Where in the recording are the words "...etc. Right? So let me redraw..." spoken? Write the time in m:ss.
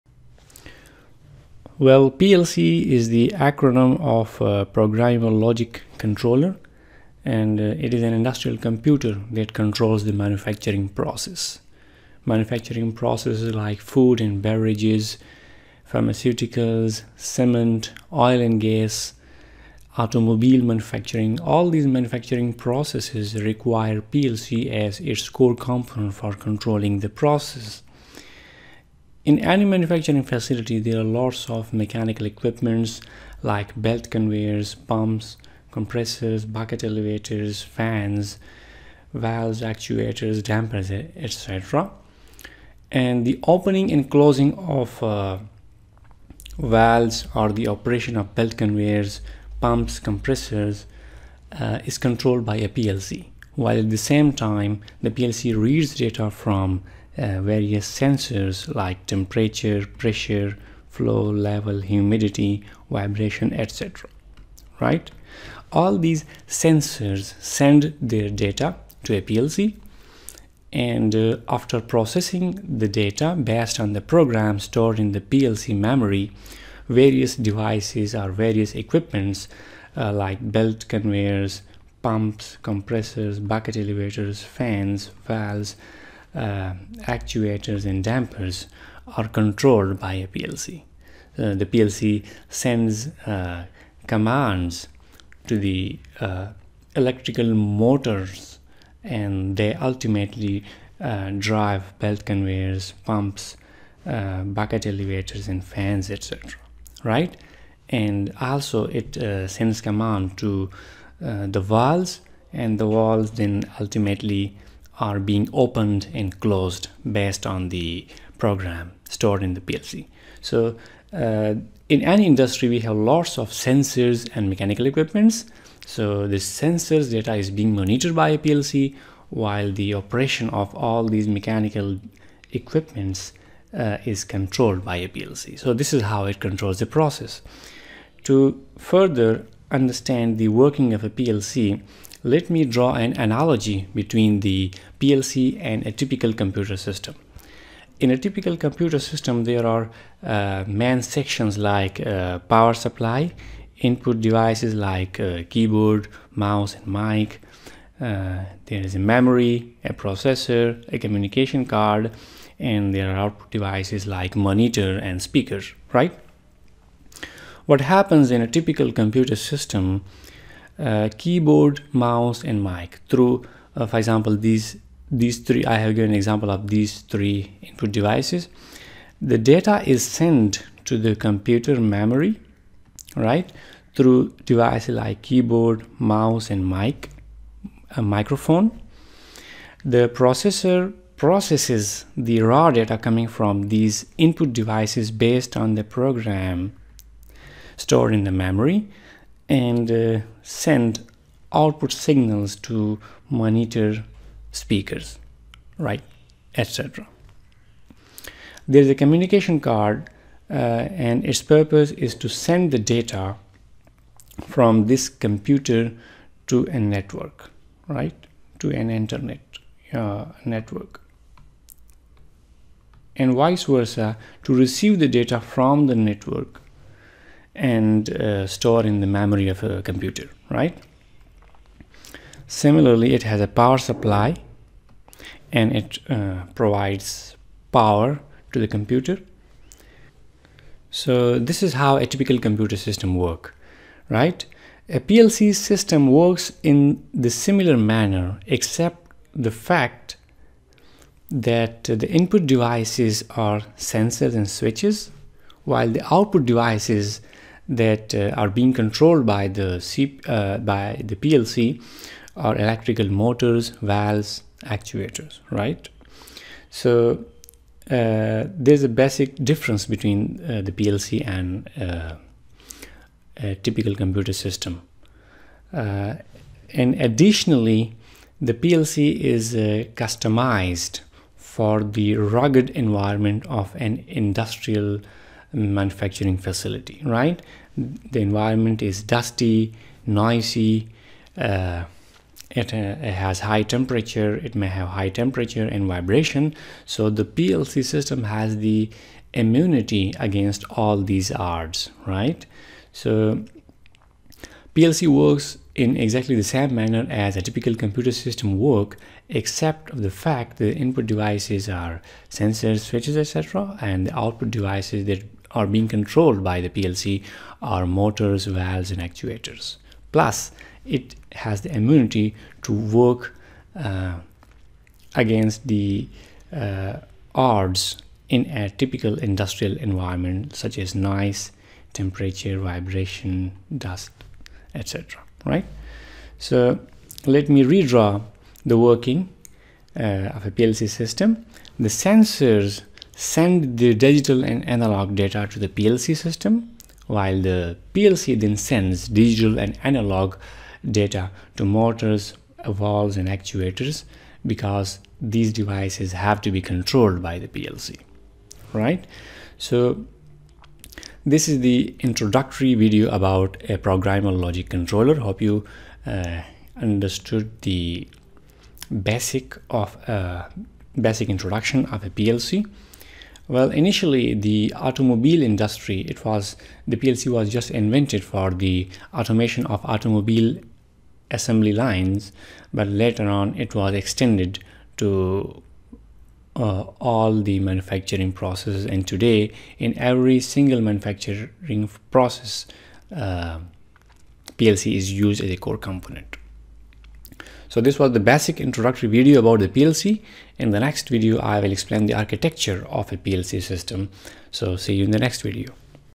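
5:34.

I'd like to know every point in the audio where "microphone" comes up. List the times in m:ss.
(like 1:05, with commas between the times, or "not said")
3:08.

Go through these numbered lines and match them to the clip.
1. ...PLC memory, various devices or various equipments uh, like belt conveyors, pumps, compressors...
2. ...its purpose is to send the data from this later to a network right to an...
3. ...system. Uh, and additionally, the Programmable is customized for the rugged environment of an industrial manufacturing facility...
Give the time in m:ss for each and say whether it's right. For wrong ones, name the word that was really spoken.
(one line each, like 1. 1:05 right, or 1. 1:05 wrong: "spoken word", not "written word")
1. 1:15 right
2. 3:31 wrong: "computer", not "later"
3. 4:34 wrong: "PLC", not "Programmable".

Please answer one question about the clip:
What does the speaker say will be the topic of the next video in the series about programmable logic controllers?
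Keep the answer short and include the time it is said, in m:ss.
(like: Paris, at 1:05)
architecture of a PLC, at 6:42.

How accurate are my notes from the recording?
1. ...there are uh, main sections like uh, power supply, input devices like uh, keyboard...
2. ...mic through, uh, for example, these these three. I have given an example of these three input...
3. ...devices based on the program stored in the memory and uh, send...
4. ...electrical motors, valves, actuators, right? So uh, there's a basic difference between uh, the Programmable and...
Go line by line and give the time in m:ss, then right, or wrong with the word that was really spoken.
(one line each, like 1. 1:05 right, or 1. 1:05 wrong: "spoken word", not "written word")
1. 2:29 right
2. 2:52 right
3. 3:14 right
4. 4:22 wrong: "PLC", not "Programmable".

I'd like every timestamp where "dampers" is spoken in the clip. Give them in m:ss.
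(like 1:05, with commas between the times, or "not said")
0:40, 1:28.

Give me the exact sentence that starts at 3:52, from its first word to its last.
Similarly, it has a power supply and it uh, provides power to the computer.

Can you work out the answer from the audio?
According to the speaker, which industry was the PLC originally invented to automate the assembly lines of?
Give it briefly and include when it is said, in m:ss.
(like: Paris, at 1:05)
automobile industry, at 6:14.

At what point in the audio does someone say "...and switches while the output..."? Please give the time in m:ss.
4:14.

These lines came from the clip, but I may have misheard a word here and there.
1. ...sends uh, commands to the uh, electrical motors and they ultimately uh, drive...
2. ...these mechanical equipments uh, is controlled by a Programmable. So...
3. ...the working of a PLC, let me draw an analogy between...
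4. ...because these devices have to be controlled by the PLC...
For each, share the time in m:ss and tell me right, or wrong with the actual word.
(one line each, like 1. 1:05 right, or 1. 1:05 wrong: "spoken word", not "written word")
1. 1:32 right
2. 2:11 wrong: "PLC", not "Programmable"
3. 2:20 right
4. 5:54 right.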